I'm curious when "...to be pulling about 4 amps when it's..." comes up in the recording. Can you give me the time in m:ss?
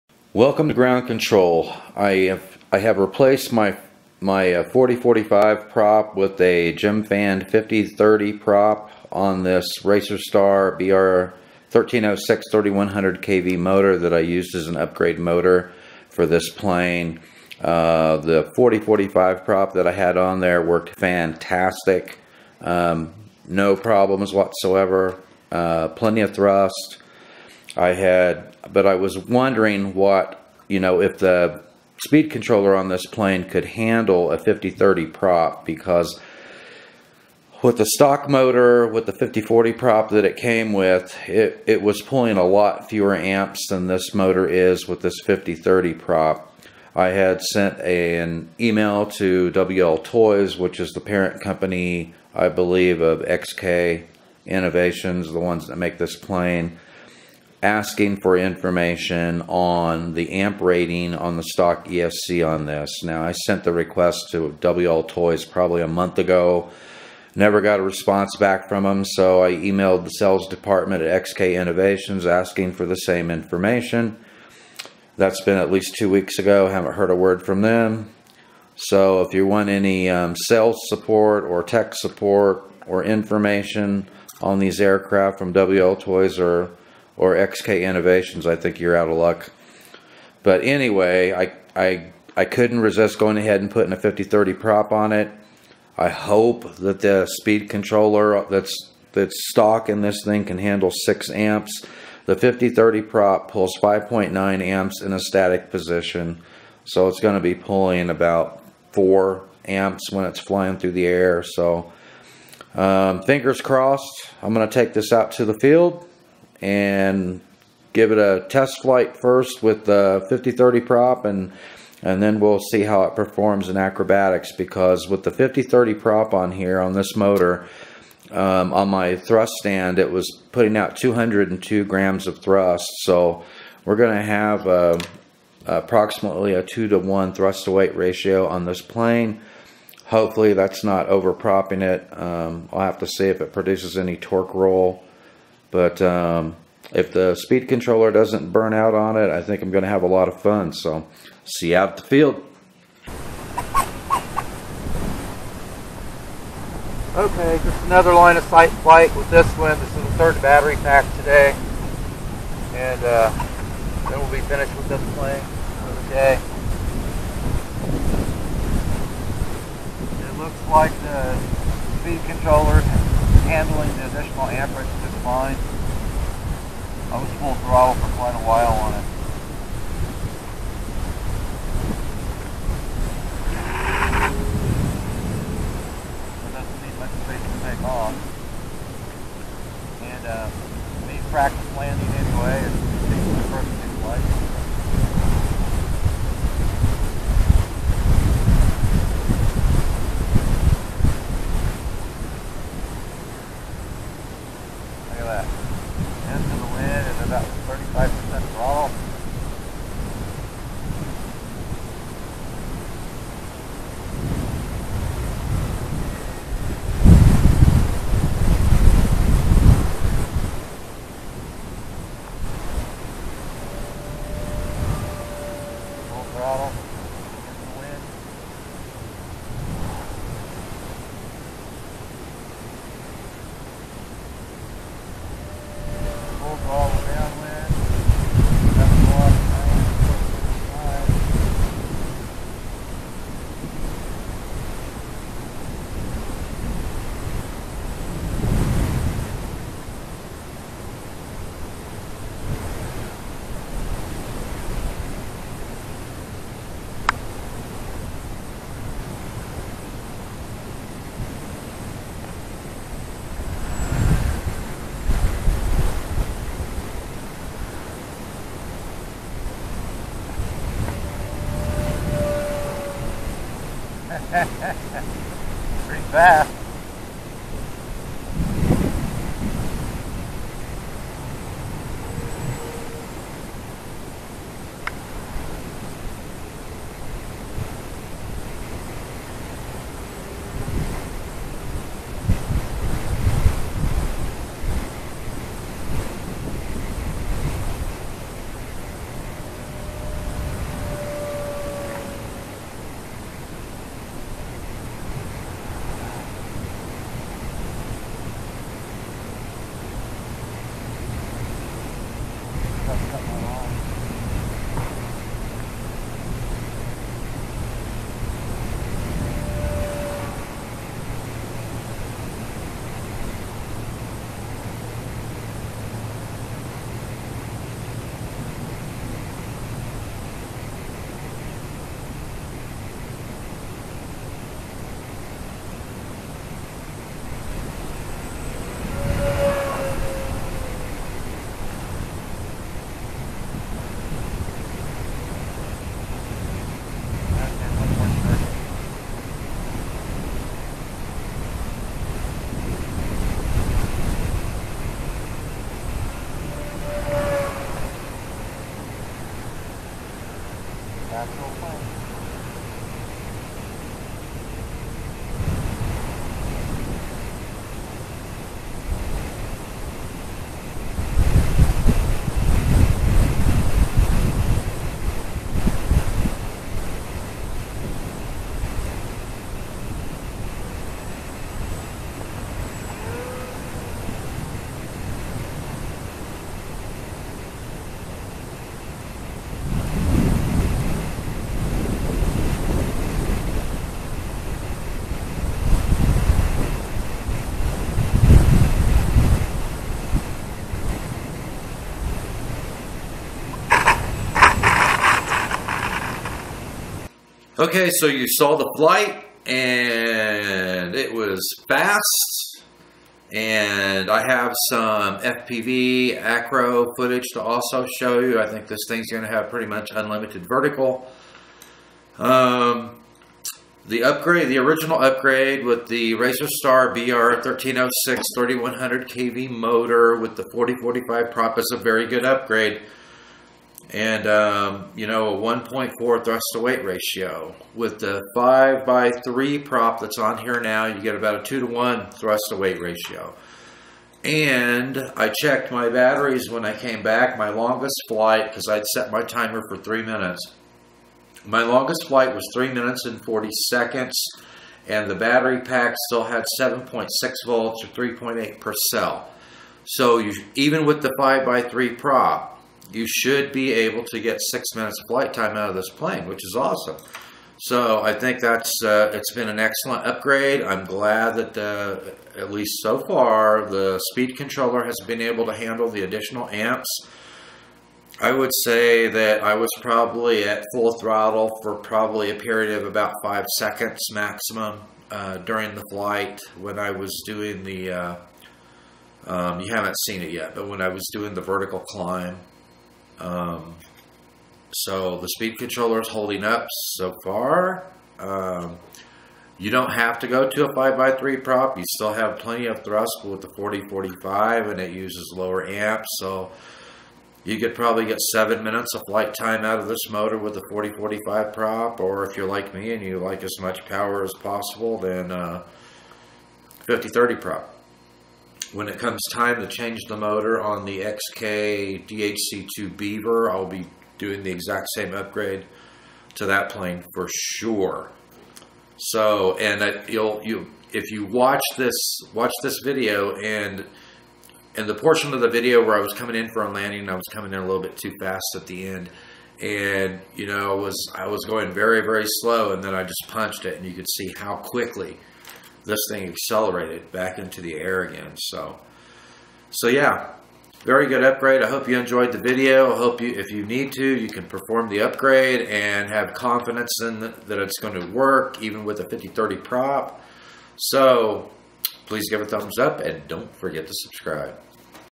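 1:47.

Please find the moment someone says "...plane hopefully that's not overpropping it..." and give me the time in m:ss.
2:18.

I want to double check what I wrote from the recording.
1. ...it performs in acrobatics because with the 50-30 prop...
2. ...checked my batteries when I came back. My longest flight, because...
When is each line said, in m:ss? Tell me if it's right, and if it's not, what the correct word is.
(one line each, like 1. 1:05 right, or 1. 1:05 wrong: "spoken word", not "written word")
1. 2:03 right
2. 7:25 right.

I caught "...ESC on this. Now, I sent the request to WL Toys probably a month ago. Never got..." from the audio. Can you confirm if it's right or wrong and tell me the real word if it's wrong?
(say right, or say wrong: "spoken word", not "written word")
right.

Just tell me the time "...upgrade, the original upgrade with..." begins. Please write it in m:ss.
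7:04.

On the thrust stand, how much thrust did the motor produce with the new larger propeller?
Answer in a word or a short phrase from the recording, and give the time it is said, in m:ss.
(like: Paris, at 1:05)
202 grams, at 2:10.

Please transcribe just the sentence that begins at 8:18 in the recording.
Um, you don't have to go to a 5x3 prop.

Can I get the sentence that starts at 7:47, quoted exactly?
So I think that's uh, it's been an excellent upgrade.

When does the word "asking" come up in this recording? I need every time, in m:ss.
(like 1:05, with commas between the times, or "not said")
0:57, 1:12.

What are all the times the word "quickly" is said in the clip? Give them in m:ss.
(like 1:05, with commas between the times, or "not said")
9:04.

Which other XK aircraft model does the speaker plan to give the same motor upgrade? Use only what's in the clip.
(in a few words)
DHC2 Beaver.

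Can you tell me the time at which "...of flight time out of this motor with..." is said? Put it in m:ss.
8:28.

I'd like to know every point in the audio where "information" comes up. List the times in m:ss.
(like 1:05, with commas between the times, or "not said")
0:58, 1:13, 1:23.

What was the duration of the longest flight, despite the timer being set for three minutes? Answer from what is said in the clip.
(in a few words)
3 minutes 40 seconds.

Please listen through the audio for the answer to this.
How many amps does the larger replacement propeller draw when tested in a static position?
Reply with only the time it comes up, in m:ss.
1:43.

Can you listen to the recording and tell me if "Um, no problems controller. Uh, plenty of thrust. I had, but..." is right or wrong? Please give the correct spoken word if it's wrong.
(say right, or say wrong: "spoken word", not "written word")
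wrong: "whatsoever", not "controller".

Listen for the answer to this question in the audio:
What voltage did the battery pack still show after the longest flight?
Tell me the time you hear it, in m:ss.
7:36.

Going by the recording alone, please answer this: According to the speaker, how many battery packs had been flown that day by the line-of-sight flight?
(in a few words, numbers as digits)
3.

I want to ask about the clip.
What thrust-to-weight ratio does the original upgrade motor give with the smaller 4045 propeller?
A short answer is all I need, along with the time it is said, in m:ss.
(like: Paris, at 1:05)
1.4, at 7:15.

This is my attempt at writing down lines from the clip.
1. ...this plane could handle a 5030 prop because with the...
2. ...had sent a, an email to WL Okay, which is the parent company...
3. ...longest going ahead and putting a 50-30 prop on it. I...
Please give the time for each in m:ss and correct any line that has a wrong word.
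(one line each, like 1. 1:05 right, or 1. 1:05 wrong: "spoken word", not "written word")
1. 0:32 right
2. 0:47 wrong: "Toys", not "Okay"
3. 1:32 wrong: "resist", not "longest".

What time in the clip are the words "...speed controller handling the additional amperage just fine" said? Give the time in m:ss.
2:51.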